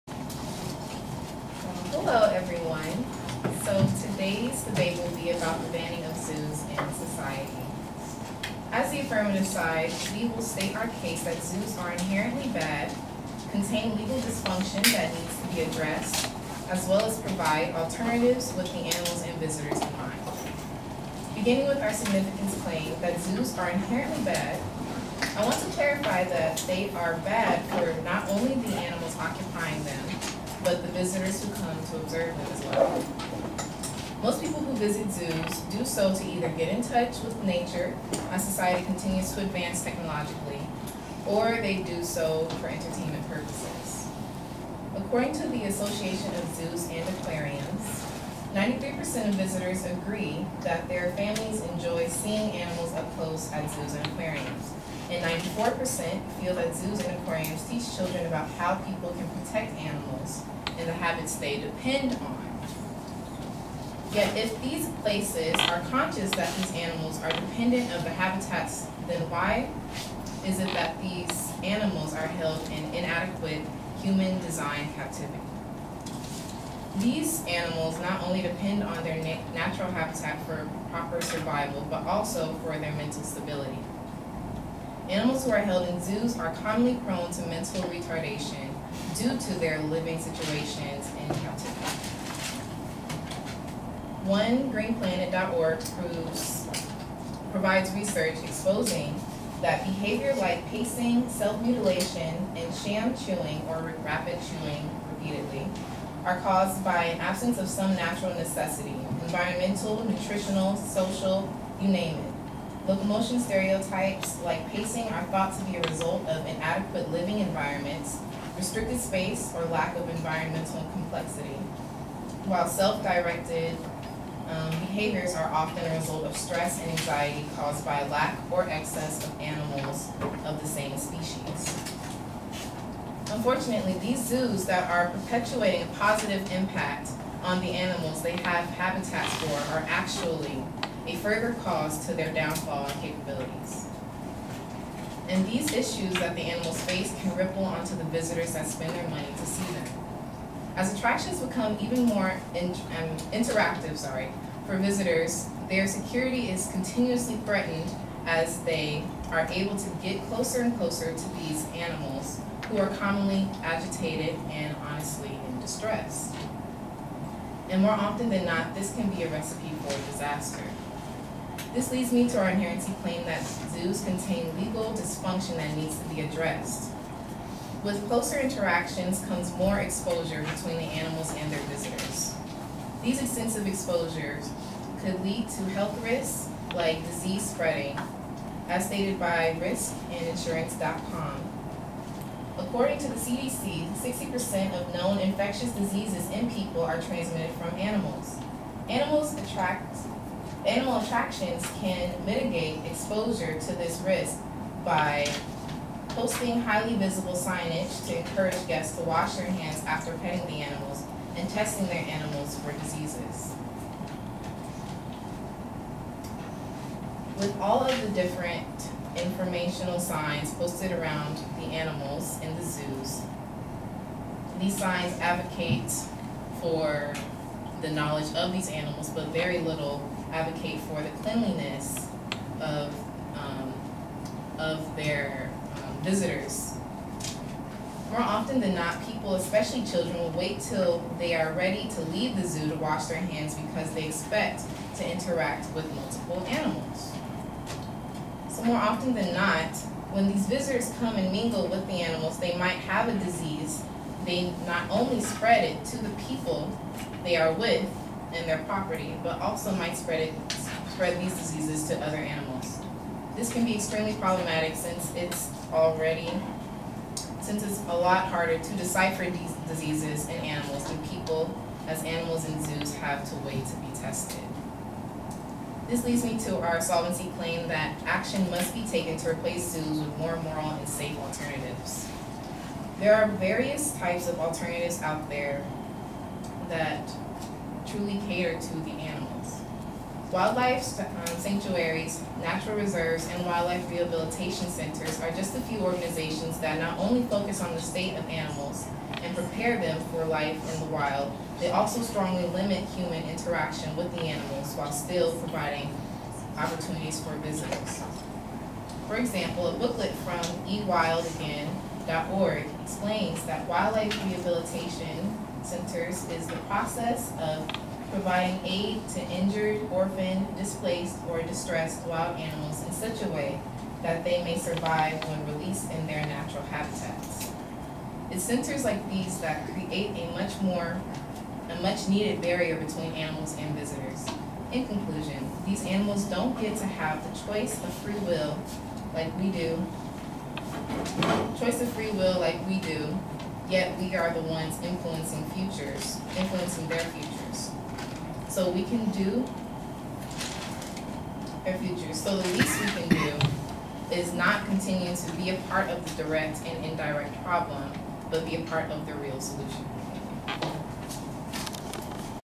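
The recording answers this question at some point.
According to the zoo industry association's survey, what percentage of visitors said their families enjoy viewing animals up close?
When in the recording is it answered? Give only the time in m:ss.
0:48.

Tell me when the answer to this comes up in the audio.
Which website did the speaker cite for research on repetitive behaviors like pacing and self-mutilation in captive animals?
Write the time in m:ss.
1:34.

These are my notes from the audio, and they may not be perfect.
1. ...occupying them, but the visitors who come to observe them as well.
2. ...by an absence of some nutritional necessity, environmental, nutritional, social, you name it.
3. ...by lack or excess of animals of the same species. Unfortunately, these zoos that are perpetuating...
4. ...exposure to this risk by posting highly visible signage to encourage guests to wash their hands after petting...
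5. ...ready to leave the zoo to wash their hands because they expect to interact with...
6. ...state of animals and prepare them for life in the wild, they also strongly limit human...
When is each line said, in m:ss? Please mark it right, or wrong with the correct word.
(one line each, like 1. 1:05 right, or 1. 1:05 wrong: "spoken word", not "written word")
1. 0:29 right
2. 1:46 wrong: "natural", not "nutritional"
3. 2:07 right
4. 3:22 right
5. 4:01 right
6. 4:57 right.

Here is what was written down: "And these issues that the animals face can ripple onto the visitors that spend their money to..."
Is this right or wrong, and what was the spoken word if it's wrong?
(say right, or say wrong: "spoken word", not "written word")
right.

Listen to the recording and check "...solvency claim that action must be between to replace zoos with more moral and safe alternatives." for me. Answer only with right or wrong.
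wrong.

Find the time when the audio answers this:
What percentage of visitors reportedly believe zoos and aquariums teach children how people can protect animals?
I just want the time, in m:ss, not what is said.
0:55.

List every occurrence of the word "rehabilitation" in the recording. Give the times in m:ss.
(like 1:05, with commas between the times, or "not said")
4:53, 5:14.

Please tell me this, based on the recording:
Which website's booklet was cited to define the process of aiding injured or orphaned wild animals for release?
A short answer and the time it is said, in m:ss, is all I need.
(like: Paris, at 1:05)
ewildagain.org, at 5:10.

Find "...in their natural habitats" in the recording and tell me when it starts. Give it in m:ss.
5:25.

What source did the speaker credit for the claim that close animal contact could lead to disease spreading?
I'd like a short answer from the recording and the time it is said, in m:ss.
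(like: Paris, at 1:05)
riskandinsurance.com, at 3:09.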